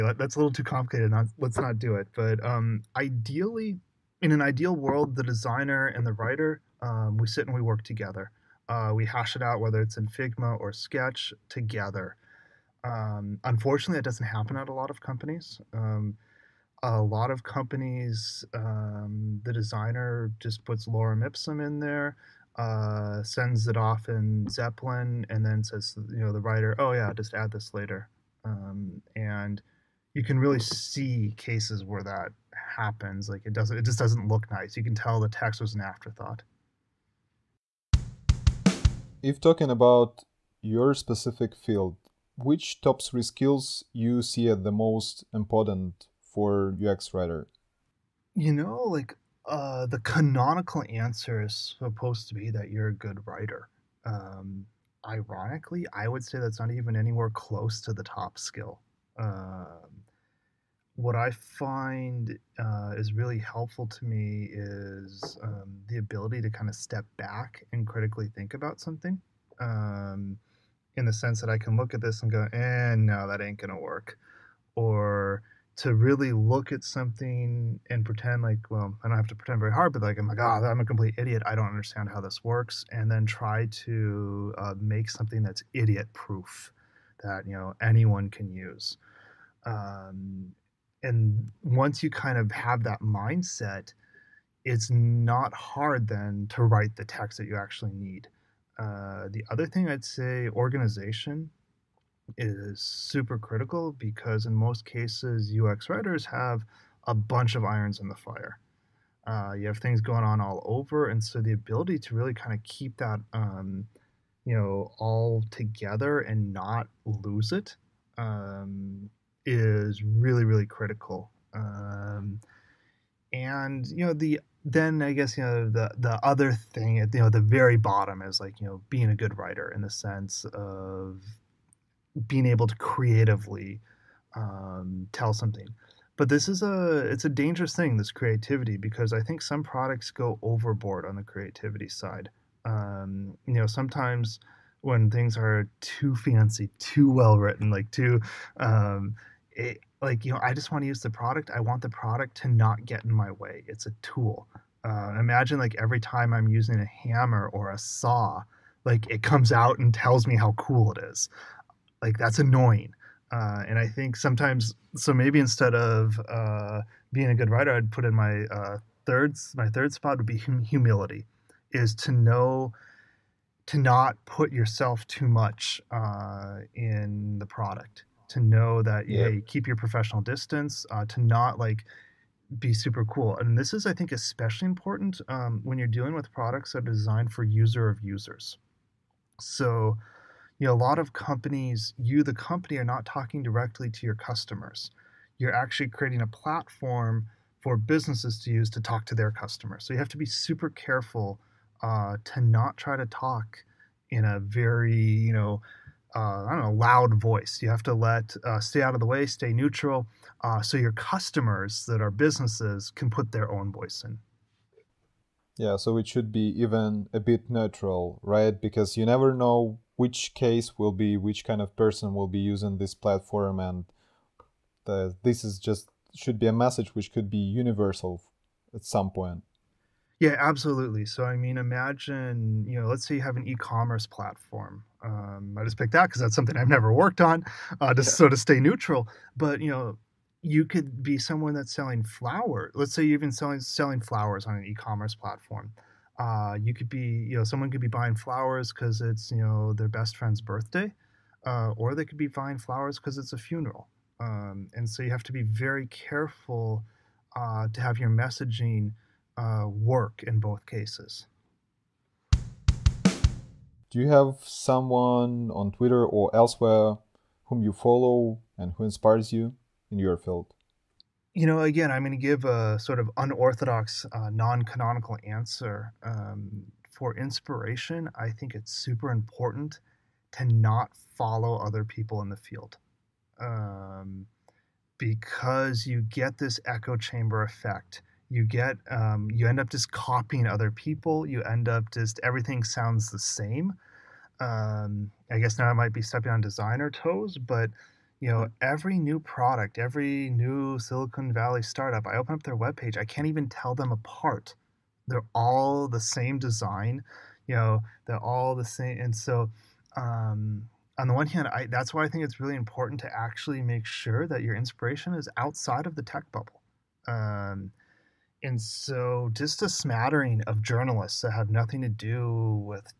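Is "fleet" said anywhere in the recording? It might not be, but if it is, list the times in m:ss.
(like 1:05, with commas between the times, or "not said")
not said.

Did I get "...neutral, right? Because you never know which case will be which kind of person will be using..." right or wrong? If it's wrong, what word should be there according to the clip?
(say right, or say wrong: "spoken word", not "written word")
right.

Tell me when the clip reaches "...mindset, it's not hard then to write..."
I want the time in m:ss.
1:32.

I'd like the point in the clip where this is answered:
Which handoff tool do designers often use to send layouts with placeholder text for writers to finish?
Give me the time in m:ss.
0:24.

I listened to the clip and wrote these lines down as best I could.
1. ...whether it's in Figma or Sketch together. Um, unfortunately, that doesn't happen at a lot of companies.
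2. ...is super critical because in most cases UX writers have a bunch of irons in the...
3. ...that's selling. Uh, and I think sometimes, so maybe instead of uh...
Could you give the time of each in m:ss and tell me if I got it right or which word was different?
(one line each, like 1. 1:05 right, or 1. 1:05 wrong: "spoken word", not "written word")
1. 0:09 right
2. 1:42 right
3. 2:42 wrong: "annoying", not "selling".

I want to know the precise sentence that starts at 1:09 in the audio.
Um, in the sense that I can look at this and go, eh, no, that ain't gonna work.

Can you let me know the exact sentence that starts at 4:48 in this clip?
You get, um, you end up just copying other people.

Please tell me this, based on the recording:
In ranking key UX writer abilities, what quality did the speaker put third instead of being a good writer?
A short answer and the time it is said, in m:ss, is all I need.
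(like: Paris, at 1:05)
Humility, at 2:50.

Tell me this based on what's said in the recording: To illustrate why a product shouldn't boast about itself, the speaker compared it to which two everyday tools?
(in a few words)
A hammer or a saw.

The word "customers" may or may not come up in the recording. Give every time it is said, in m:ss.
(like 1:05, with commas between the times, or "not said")
3:14, 3:19, 3:30.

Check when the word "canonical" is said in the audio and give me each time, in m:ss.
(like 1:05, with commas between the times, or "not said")
0:49, 4:34.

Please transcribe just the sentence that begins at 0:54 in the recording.
Um, ironically, I would say that's not even anywhere close to the top skill.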